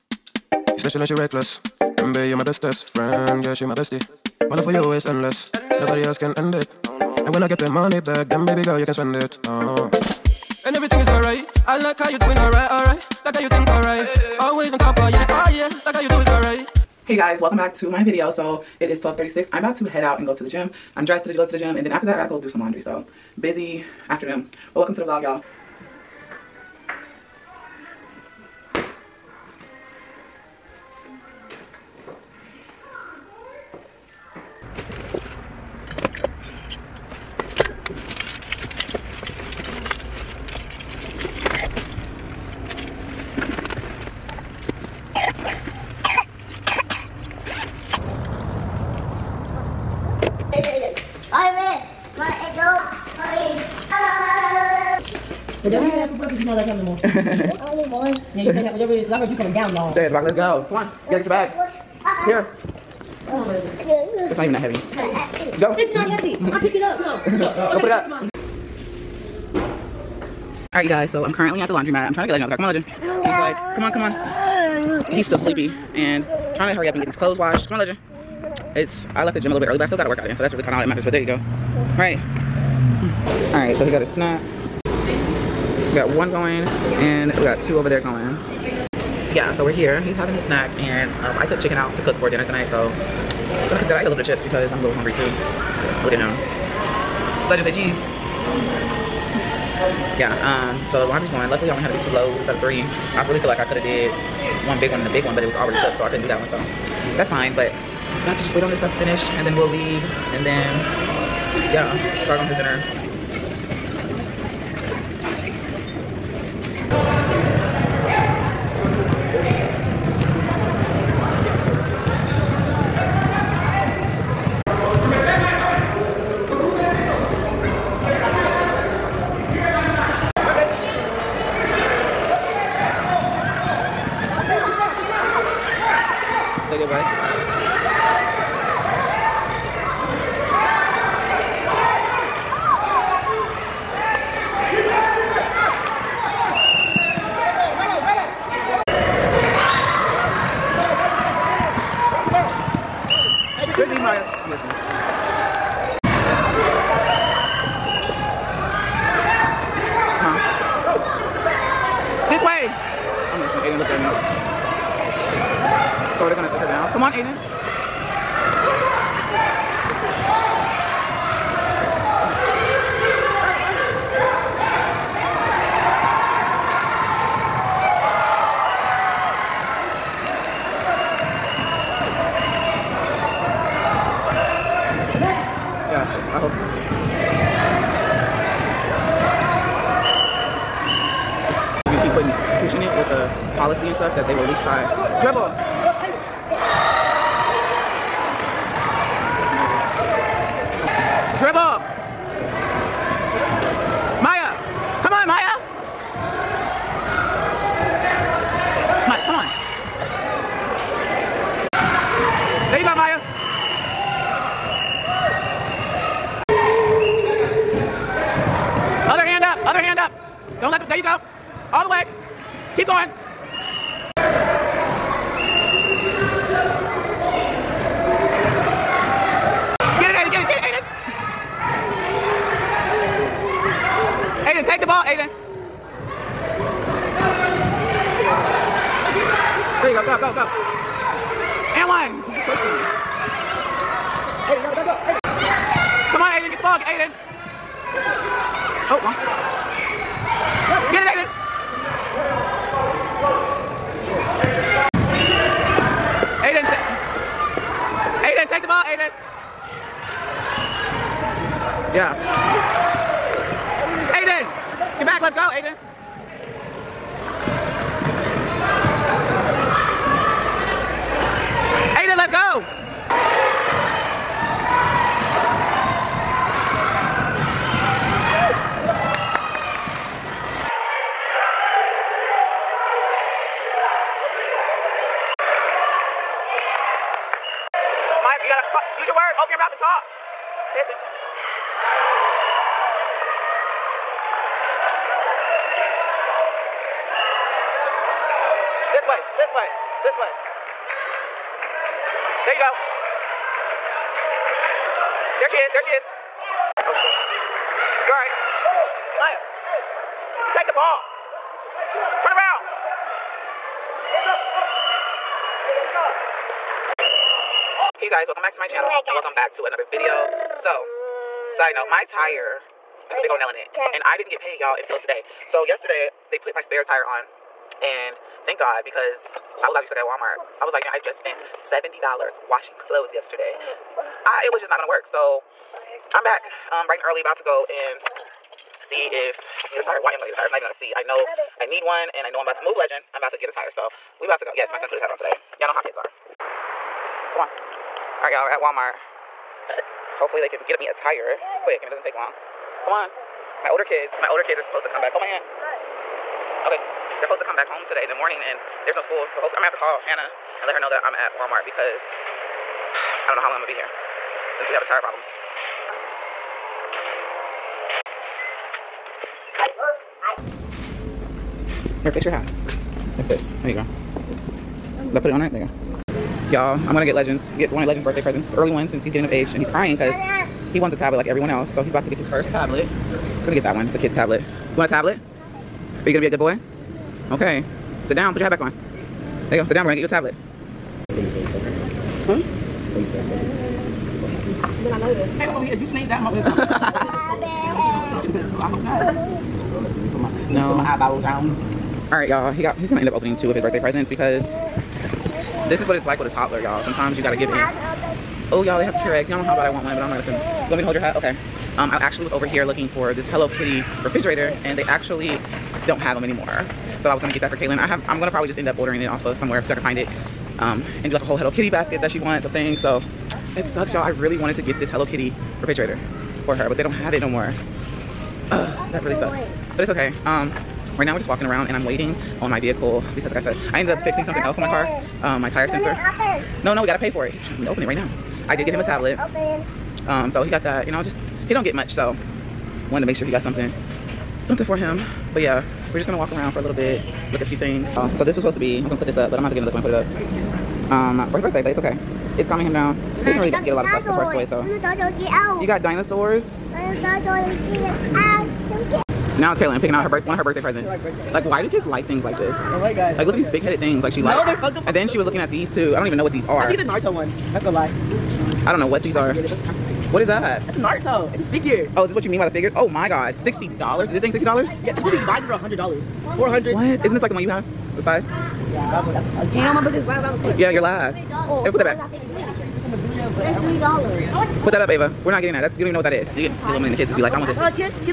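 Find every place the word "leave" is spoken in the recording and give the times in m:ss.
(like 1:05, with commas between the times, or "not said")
1:49.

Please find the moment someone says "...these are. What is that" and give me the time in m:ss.
7:49.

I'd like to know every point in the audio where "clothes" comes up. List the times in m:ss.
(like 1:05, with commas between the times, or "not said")
1:17, 5:32.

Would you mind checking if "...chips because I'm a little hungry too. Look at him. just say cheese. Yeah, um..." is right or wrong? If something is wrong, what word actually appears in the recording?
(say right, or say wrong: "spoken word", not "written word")
right.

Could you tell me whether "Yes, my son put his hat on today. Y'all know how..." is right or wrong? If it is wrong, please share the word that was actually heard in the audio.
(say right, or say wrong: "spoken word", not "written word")
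right.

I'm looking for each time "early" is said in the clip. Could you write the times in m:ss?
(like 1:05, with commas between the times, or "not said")
1:19, 5:37, 6:18.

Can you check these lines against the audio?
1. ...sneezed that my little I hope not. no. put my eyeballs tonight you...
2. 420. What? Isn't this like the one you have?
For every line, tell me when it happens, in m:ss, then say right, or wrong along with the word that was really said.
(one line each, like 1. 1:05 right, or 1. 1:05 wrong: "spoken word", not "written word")
1. 6:35 wrong: "alright", not "tonight"
2. 7:56 wrong: "400", not "420".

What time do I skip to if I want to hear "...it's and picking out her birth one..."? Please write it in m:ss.
7:39.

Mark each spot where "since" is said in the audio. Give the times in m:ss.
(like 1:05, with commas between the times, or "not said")
6:04, 6:18.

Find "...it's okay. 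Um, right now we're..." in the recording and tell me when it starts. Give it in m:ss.
7:09.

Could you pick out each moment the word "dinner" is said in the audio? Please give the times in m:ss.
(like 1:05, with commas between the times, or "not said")
1:32, 1:52.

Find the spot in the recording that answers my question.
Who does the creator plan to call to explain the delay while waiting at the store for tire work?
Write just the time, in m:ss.
5:59.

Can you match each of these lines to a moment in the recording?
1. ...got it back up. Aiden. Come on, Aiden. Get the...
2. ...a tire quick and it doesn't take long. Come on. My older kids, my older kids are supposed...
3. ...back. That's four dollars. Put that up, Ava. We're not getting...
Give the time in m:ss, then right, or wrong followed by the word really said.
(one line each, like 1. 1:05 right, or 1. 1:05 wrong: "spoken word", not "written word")
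1. 4:04 right
2. 5:50 right
3. 8:01 wrong: "three", not "four".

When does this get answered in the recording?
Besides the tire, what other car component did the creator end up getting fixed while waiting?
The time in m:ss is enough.
7:15.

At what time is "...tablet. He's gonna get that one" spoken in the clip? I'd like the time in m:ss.
6:22.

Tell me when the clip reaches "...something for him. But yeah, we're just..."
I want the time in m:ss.
7:24.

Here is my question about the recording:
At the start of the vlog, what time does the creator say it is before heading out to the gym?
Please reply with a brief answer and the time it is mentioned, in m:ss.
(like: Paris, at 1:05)
12:36, at 0:19.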